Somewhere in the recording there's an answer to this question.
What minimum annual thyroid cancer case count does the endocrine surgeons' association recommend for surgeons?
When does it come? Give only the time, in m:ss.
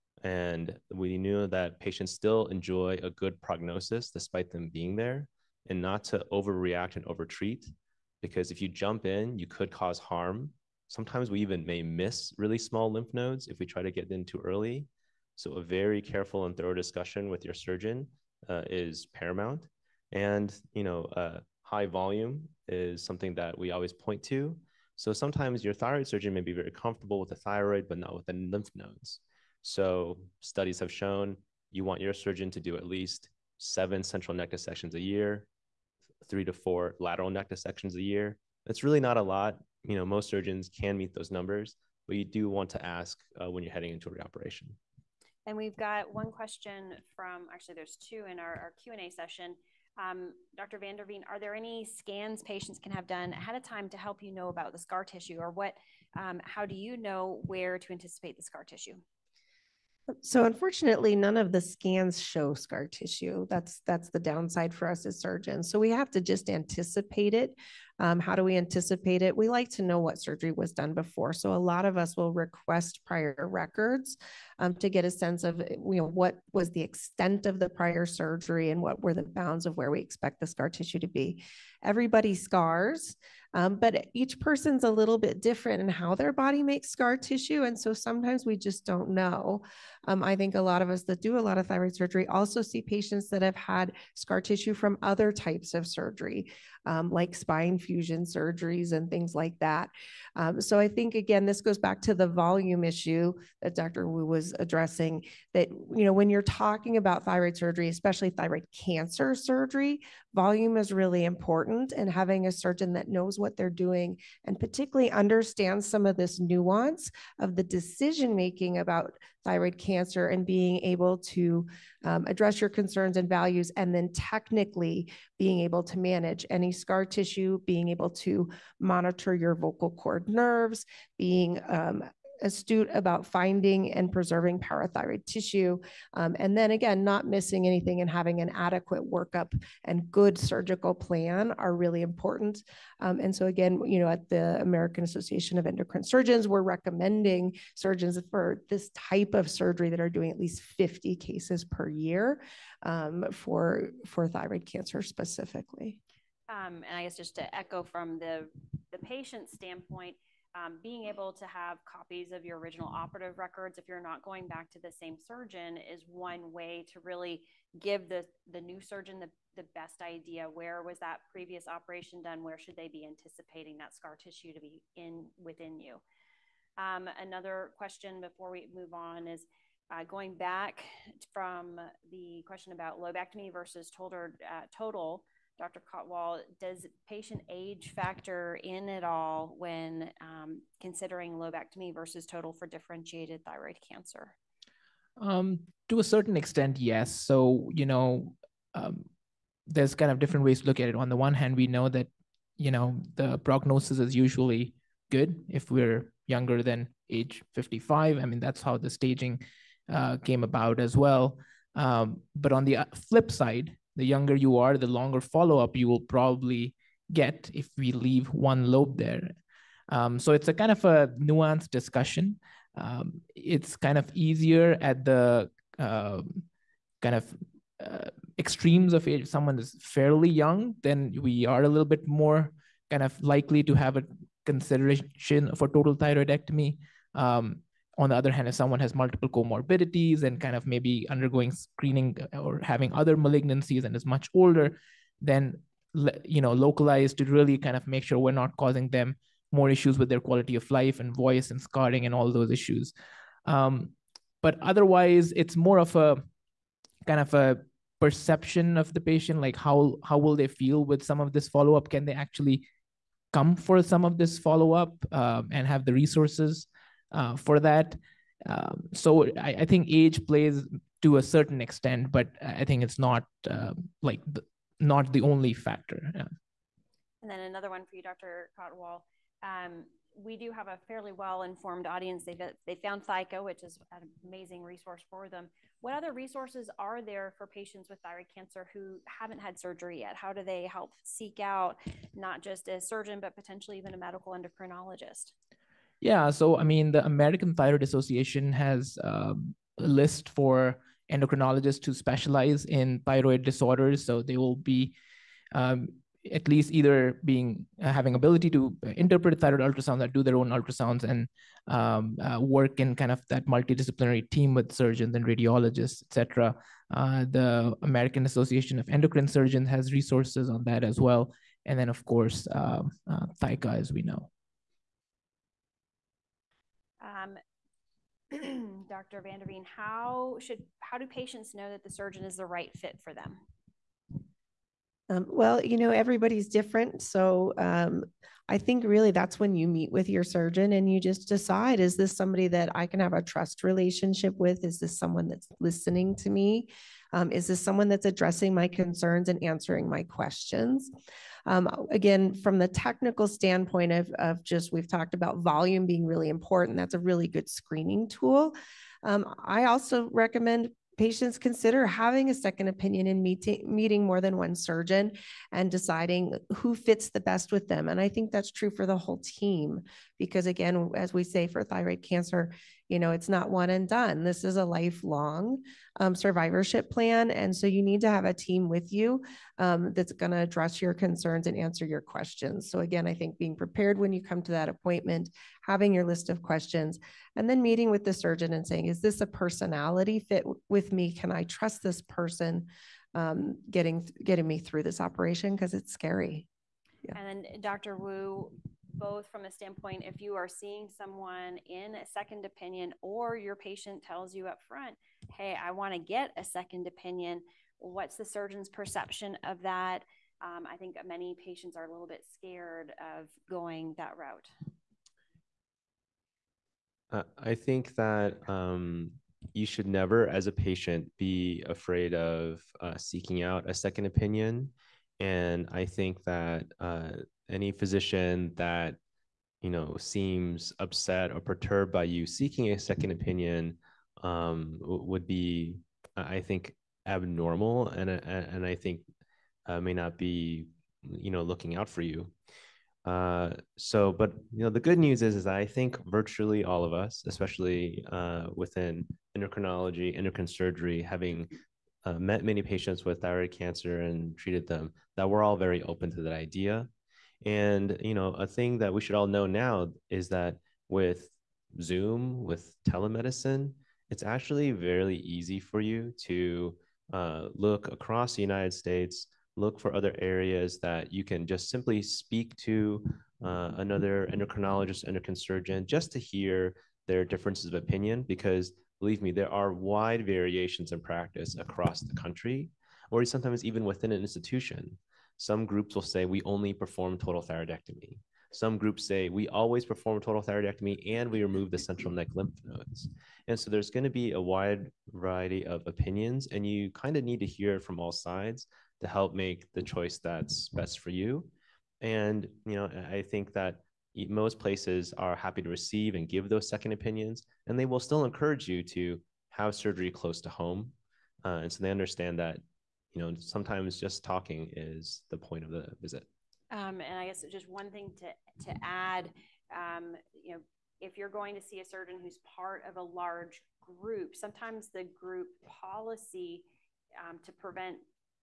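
2:30.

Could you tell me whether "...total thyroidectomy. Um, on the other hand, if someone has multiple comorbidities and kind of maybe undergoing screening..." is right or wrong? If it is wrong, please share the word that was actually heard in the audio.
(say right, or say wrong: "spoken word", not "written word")
right.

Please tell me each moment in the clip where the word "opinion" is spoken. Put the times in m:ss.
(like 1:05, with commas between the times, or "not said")
6:02, 6:42, 6:46, 7:04, 7:13, 7:57, 8:15, 8:26.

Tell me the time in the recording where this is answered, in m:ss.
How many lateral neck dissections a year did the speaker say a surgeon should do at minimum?
0:36.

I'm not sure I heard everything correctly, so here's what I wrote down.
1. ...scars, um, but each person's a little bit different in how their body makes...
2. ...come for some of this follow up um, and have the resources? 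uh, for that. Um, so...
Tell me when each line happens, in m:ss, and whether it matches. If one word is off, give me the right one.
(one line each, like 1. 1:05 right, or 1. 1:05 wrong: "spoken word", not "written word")
1. 1:22 right
2. 4:23 right.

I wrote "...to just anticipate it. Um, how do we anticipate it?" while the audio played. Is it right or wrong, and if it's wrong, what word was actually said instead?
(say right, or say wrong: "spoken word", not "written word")
right.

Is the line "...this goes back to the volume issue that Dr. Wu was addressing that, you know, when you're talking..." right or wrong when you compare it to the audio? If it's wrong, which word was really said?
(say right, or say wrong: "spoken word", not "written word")
right.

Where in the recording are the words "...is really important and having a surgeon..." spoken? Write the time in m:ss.
1:50.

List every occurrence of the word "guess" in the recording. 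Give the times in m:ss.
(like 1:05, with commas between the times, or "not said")
2:37, 8:37.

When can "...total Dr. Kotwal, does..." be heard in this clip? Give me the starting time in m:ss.
3:04.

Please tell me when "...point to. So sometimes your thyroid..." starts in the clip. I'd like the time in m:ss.
0:23.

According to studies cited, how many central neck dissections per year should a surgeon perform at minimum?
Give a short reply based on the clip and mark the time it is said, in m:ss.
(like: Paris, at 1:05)
7, at 0:33.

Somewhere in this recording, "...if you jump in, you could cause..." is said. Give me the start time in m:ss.
0:08.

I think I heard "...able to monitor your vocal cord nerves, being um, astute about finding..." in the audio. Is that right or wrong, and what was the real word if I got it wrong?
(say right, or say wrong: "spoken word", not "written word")
right.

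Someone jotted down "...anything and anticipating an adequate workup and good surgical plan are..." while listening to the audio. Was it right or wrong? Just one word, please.
wrong.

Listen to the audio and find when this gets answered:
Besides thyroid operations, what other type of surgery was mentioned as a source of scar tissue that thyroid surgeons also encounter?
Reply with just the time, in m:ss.
1:37.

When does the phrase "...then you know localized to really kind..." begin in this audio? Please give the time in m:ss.
4:05.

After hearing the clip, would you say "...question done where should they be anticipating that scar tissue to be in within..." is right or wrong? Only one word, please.
wrong.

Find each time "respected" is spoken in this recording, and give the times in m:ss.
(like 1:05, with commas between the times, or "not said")
not said.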